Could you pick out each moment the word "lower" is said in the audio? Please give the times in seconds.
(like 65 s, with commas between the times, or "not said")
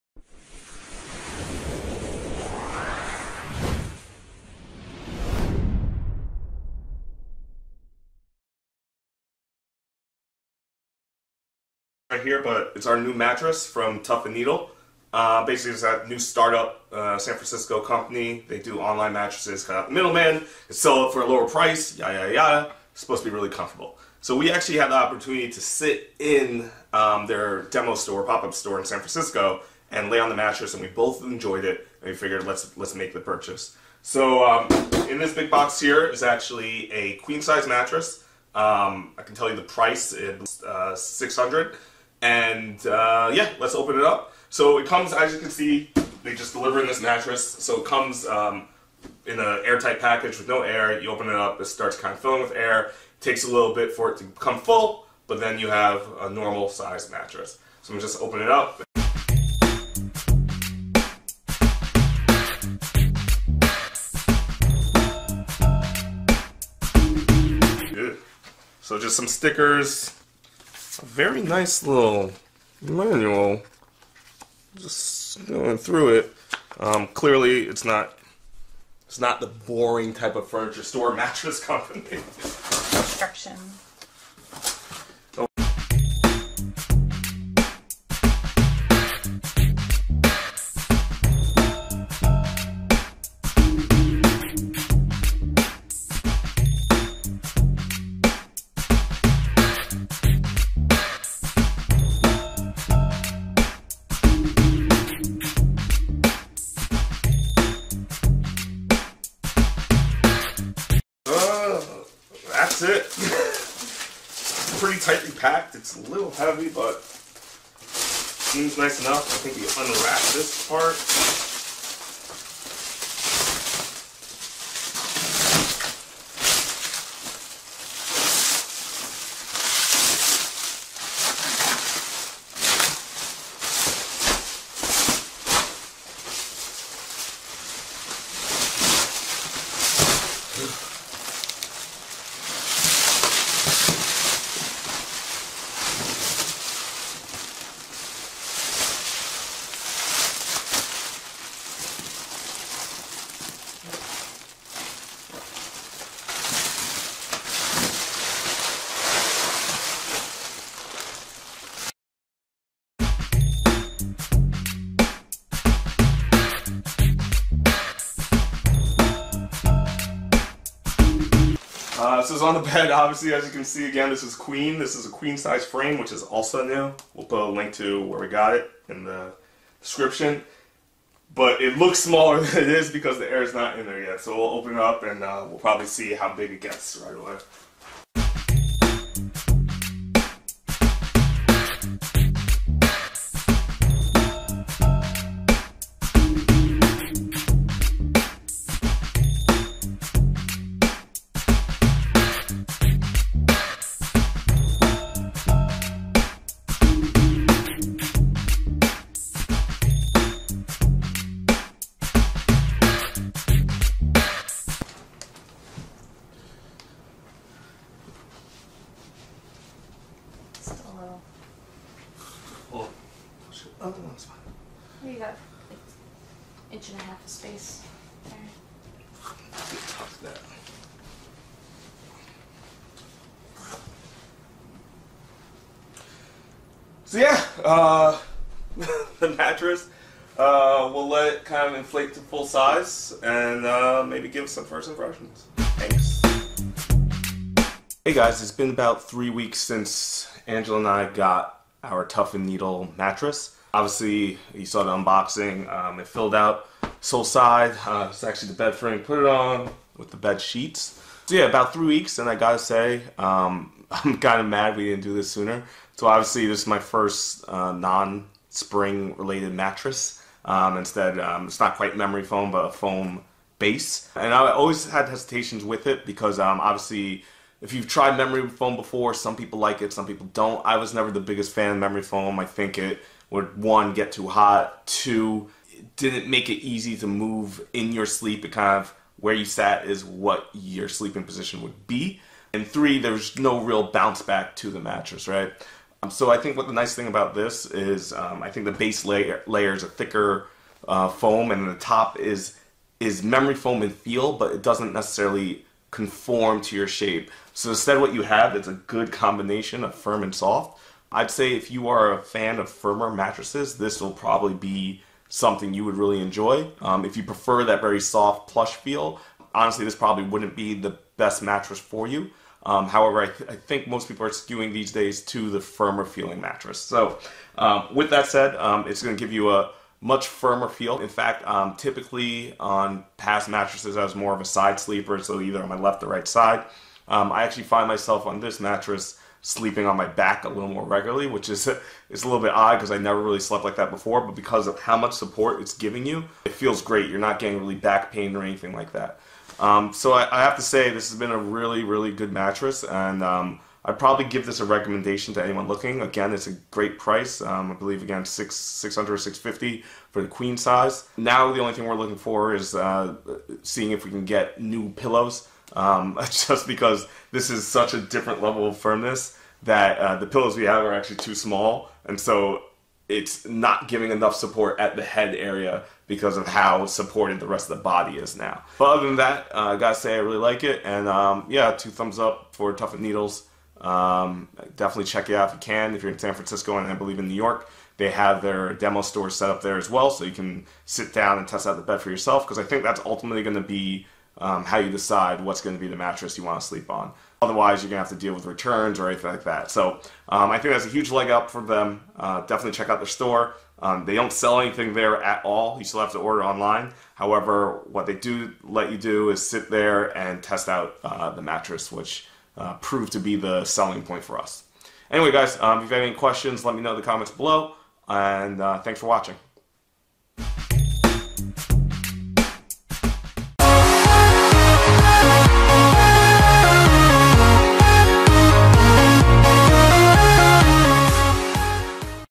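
21 s.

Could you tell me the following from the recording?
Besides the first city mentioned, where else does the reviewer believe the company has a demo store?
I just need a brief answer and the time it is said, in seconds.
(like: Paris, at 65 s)
New York, at 387 s.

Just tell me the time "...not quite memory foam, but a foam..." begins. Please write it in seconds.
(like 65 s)
271 s.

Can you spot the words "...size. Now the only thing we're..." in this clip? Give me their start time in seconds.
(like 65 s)
360 s.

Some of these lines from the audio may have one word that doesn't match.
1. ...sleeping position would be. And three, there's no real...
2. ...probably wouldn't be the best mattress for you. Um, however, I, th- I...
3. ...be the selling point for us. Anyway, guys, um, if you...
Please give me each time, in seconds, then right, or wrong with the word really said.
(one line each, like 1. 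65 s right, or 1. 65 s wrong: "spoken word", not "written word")
1. 290 s right
2. 319 s right
3. 413 s right.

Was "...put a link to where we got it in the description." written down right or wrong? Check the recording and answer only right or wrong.
right.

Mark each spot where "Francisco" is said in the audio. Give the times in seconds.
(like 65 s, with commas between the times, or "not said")
17 s, 28 s, 386 s.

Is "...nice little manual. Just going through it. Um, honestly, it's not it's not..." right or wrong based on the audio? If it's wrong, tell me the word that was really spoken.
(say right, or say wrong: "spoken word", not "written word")
wrong: "clearly", not "honestly".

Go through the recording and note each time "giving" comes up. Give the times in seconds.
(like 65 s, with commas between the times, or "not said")
345 s, 373 s.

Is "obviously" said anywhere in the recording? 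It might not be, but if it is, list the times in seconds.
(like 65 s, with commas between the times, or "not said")
172 s, 253 s, 266 s, 276 s.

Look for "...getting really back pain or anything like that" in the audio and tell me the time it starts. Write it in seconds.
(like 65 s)
347 s.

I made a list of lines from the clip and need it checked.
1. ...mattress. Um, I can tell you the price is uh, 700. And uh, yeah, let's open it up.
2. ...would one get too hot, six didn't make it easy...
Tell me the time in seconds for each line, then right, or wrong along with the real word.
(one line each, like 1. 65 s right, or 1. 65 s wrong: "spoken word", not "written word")
1. 37 s wrong: "600", not "700"
2. 283 s wrong: "two", not "six".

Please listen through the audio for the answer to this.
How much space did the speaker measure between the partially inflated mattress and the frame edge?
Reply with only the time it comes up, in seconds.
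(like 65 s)
226 s.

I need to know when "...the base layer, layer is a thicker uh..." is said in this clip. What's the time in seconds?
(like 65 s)
298 s.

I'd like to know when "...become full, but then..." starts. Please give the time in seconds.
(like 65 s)
54 s.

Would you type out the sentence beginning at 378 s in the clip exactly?
But other than that, uh, I gotta say I really like it, and um, yeah, two thumbs up for Tuft and Needles.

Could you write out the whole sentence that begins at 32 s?
And we figured let's let's make the purchase.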